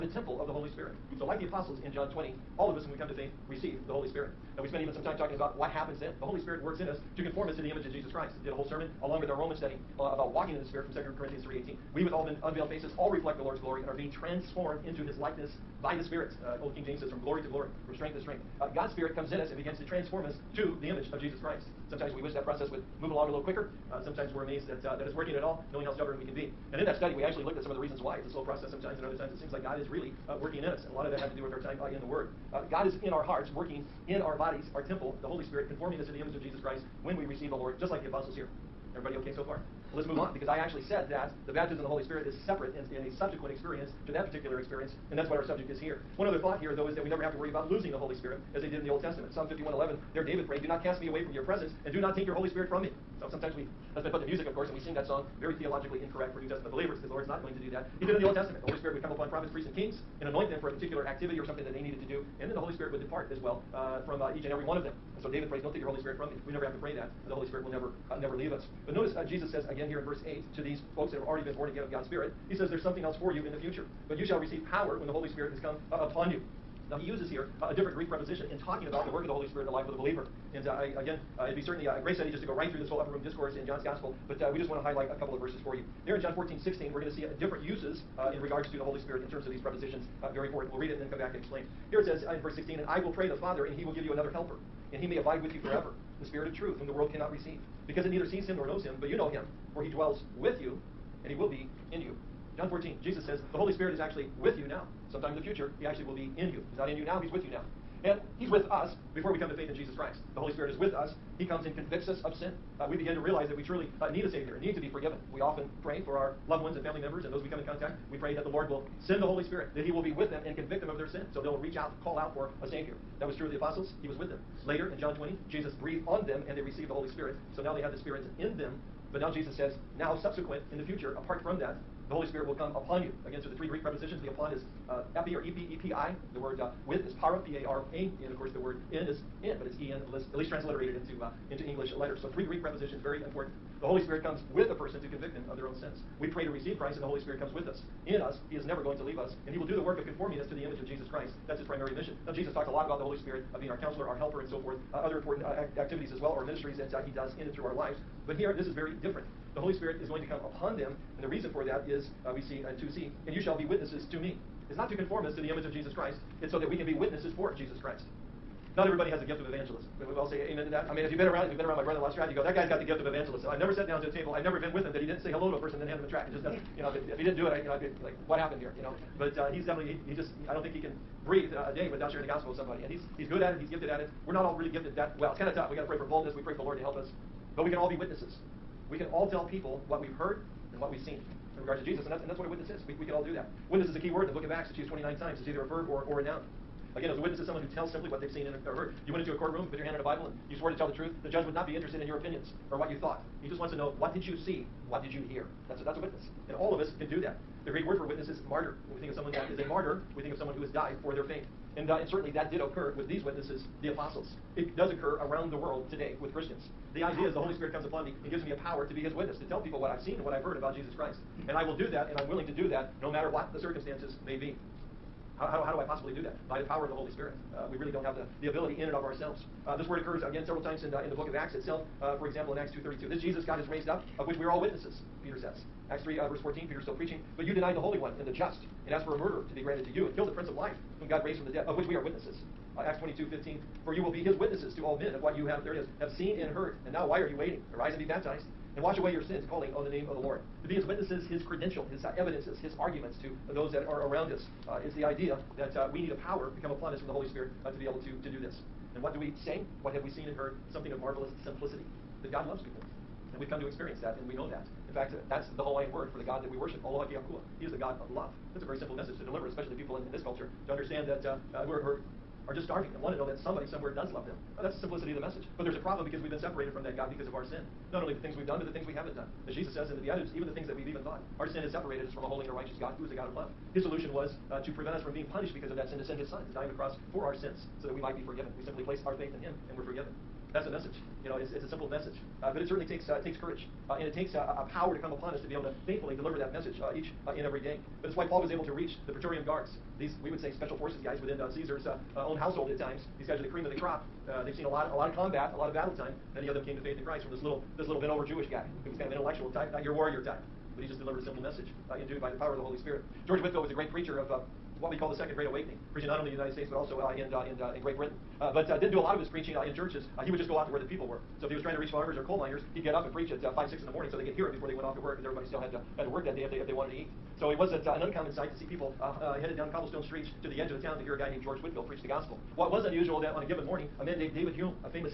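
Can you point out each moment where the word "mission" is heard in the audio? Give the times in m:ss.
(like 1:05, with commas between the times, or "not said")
2:31.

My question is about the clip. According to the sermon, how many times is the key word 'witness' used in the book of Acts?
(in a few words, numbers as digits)
29.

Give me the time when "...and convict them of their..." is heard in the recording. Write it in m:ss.
2:00.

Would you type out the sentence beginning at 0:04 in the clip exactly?
Now, we spent even some time talking about what happens then.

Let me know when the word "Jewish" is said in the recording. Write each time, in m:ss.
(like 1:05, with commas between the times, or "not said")
5:08.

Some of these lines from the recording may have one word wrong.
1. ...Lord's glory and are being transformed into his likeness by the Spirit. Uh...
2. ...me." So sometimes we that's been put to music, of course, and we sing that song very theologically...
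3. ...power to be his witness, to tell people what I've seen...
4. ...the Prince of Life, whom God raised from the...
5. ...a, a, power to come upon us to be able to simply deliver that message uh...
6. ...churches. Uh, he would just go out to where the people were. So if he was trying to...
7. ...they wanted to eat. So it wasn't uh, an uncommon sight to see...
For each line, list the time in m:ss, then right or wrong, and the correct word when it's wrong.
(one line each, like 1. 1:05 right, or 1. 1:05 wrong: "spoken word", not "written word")
1. 0:13 right
2. 0:52 right
3. 3:38 right
4. 4:00 right
5. 4:54 wrong: "faithfully", not "simply"
6. 5:19 right
7. 5:26 right.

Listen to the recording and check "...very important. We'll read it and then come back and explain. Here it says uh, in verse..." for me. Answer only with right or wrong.
right.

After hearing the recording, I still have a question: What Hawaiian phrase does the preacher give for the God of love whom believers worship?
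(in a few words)
Aloha ke Akua.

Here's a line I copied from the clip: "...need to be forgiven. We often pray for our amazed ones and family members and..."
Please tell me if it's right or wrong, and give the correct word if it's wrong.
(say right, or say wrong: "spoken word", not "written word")
wrong: "loved", not "amazed".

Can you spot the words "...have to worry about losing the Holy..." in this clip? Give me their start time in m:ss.
0:47.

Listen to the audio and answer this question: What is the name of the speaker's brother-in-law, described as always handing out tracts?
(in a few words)
Strad.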